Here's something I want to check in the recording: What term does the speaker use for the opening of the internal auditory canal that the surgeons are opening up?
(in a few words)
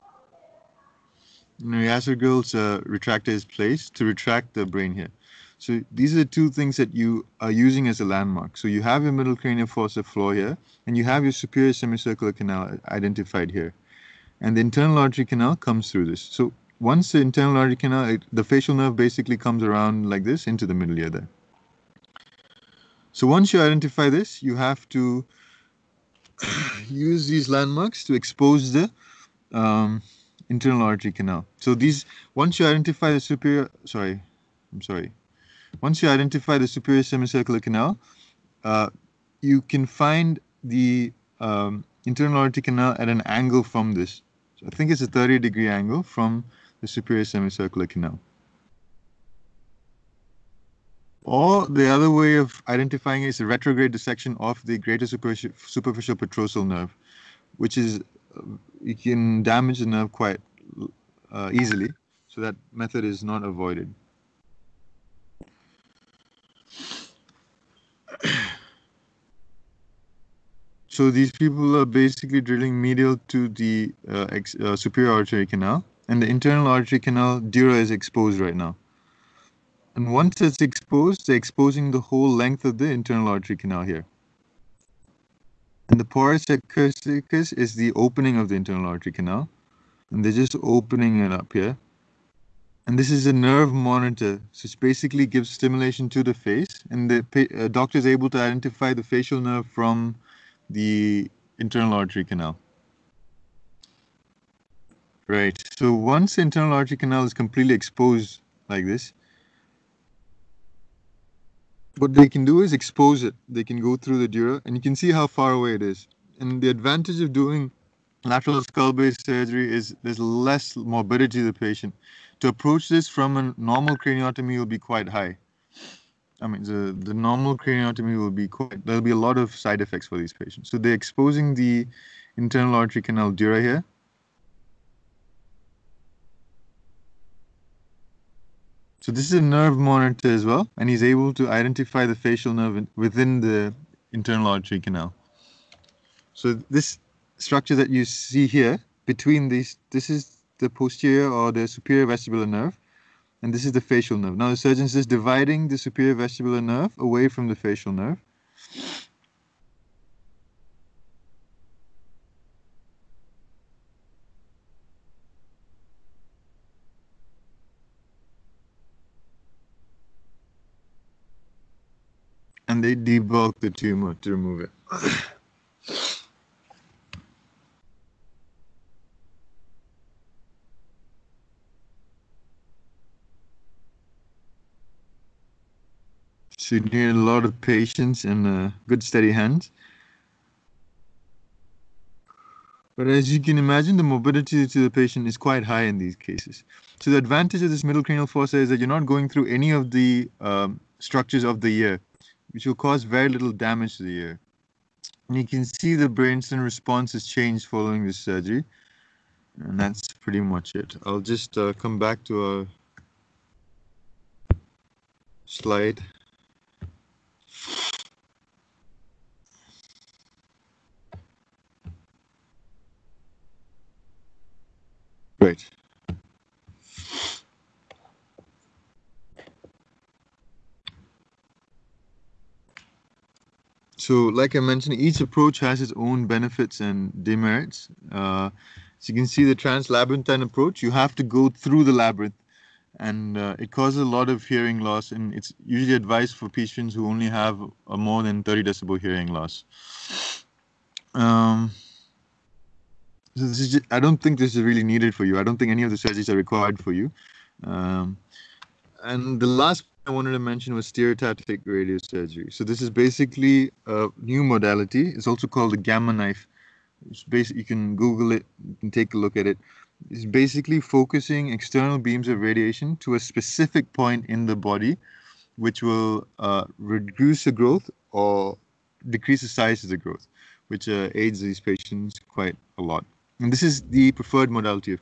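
pars acusticus.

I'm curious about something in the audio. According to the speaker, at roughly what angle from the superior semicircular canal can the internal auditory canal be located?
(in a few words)
30 degrees.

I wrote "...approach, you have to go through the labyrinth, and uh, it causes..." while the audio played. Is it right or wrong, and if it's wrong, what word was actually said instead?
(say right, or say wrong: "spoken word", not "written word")
right.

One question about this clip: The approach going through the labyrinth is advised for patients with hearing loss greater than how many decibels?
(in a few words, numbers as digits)
30 decibels.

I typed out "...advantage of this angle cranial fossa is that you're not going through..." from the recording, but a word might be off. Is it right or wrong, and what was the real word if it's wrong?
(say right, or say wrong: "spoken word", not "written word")
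wrong: "middle", not "angle".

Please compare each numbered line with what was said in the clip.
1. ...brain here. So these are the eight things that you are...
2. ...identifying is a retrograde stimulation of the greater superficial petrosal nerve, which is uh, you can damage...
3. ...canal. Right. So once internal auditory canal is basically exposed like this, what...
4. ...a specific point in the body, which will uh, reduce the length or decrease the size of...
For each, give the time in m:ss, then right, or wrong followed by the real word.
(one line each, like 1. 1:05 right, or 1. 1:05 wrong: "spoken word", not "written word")
1. 0:04 wrong: "two", not "eight"
2. 0:52 wrong: "dissection", not "stimulation"
3. 1:42 wrong: "completely", not "basically"
4. 4:33 wrong: "growth", not "length".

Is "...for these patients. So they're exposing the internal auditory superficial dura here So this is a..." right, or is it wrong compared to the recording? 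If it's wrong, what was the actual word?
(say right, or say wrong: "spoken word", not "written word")
wrong: "canal", not "superficial".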